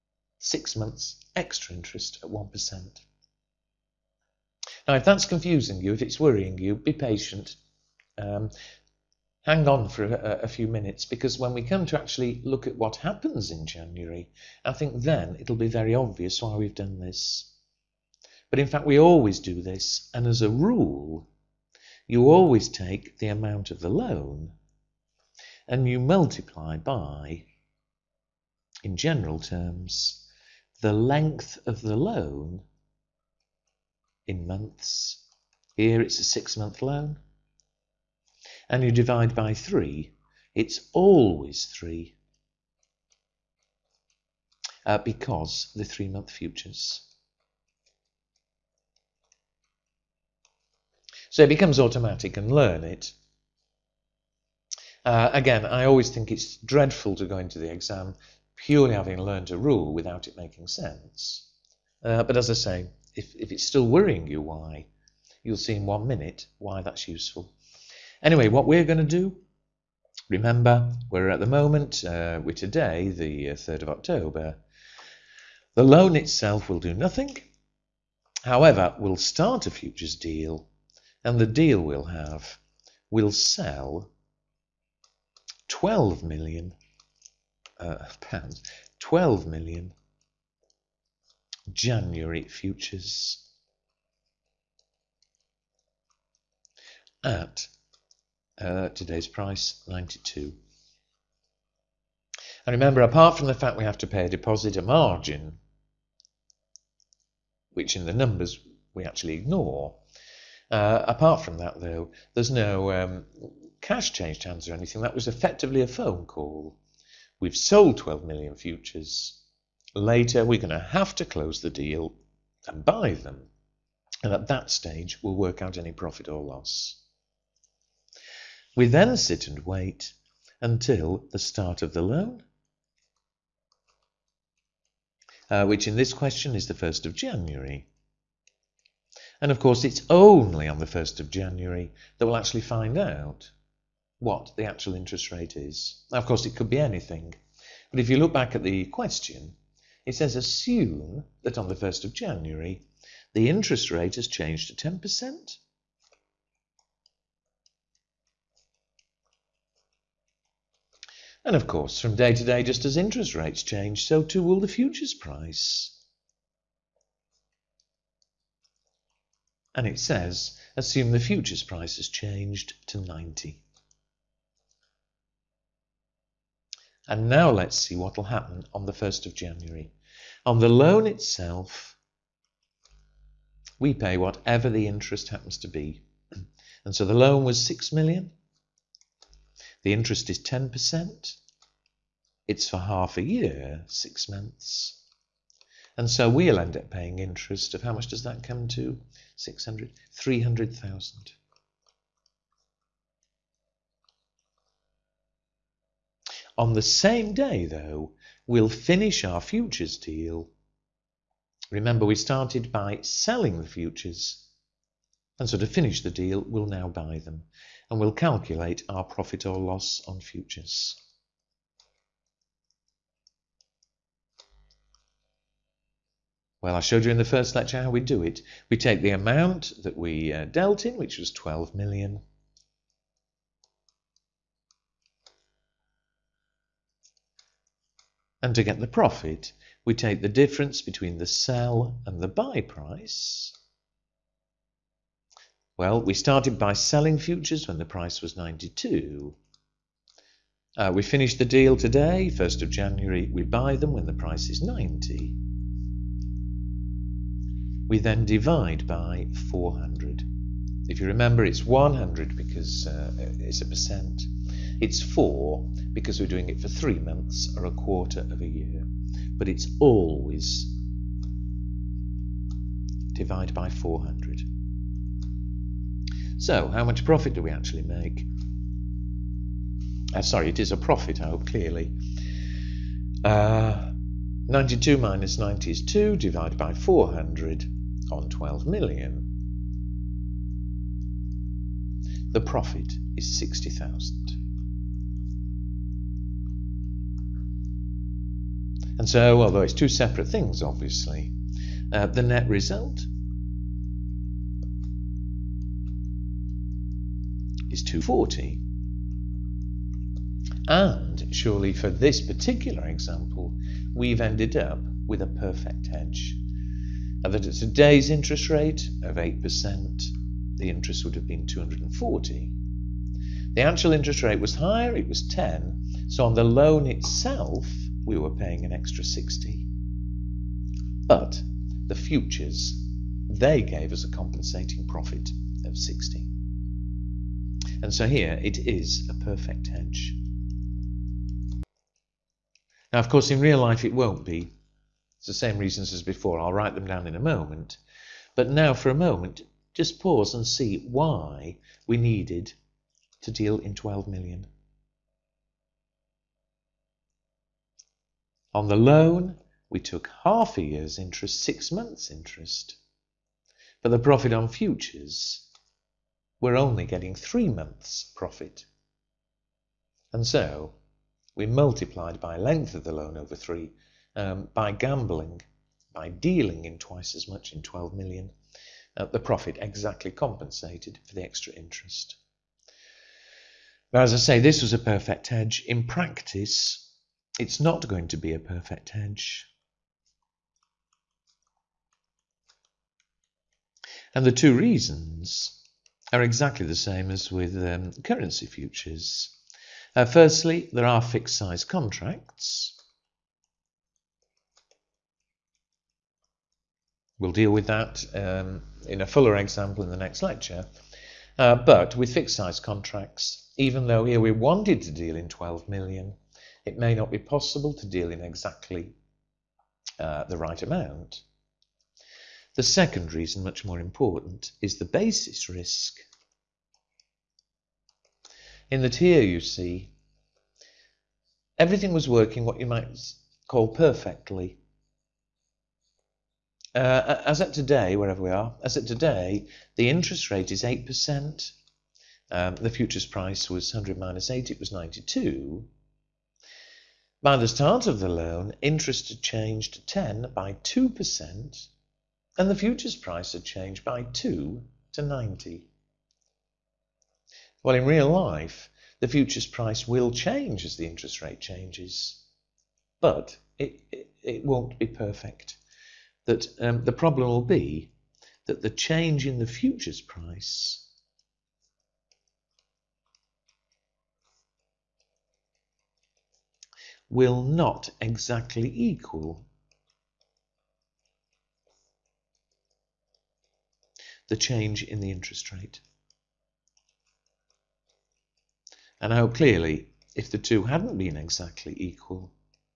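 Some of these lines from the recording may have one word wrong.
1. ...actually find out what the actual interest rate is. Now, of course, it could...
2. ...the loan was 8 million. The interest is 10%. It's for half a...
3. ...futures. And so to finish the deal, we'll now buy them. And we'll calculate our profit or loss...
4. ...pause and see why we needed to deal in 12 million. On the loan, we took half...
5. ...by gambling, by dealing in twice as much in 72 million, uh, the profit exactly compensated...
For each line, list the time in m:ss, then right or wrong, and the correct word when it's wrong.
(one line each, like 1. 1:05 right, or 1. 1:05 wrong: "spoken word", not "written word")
1. 2:22 right
2. 3:07 wrong: "6", not "8"
3. 3:33 right
4. 5:50 right
5. 6:14 wrong: "12", not "72".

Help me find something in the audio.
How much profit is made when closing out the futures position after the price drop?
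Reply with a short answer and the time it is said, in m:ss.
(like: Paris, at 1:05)
60,000, at 4:53.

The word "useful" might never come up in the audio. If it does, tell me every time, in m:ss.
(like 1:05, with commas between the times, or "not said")
1:07.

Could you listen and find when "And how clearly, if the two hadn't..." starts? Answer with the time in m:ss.
8:09.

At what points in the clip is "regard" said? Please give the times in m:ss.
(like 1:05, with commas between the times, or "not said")
not said.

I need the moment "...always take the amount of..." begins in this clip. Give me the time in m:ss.
0:22.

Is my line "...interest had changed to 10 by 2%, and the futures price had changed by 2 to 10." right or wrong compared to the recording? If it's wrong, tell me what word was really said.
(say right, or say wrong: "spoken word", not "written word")
wrong: "90", not "10".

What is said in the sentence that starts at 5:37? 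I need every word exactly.
And so here it is a perfect hedge.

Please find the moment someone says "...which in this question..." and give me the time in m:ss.
2:15.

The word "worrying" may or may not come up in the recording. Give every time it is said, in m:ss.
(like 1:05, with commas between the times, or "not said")
0:06, 1:03.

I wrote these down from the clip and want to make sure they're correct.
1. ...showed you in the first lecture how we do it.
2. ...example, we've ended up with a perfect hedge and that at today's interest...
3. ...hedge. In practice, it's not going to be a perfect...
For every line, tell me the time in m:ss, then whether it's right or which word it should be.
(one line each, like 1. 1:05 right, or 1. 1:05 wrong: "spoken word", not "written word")
1. 3:46 right
2. 5:12 right
3. 6:25 right.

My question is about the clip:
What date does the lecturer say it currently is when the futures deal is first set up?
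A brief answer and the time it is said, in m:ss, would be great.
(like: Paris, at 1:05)
3rd of October, at 1:13.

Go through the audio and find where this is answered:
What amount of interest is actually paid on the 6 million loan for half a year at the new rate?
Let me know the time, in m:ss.
3:20.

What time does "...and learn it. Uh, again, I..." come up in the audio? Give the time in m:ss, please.
0:52.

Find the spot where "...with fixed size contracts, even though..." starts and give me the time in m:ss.
6:51.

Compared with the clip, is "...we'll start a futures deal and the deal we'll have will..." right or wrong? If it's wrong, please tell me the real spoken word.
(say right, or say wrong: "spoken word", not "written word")
right.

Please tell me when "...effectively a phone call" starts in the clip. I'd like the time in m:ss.
1:55.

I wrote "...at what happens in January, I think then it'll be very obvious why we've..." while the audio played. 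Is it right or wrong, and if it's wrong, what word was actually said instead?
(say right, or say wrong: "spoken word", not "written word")
right.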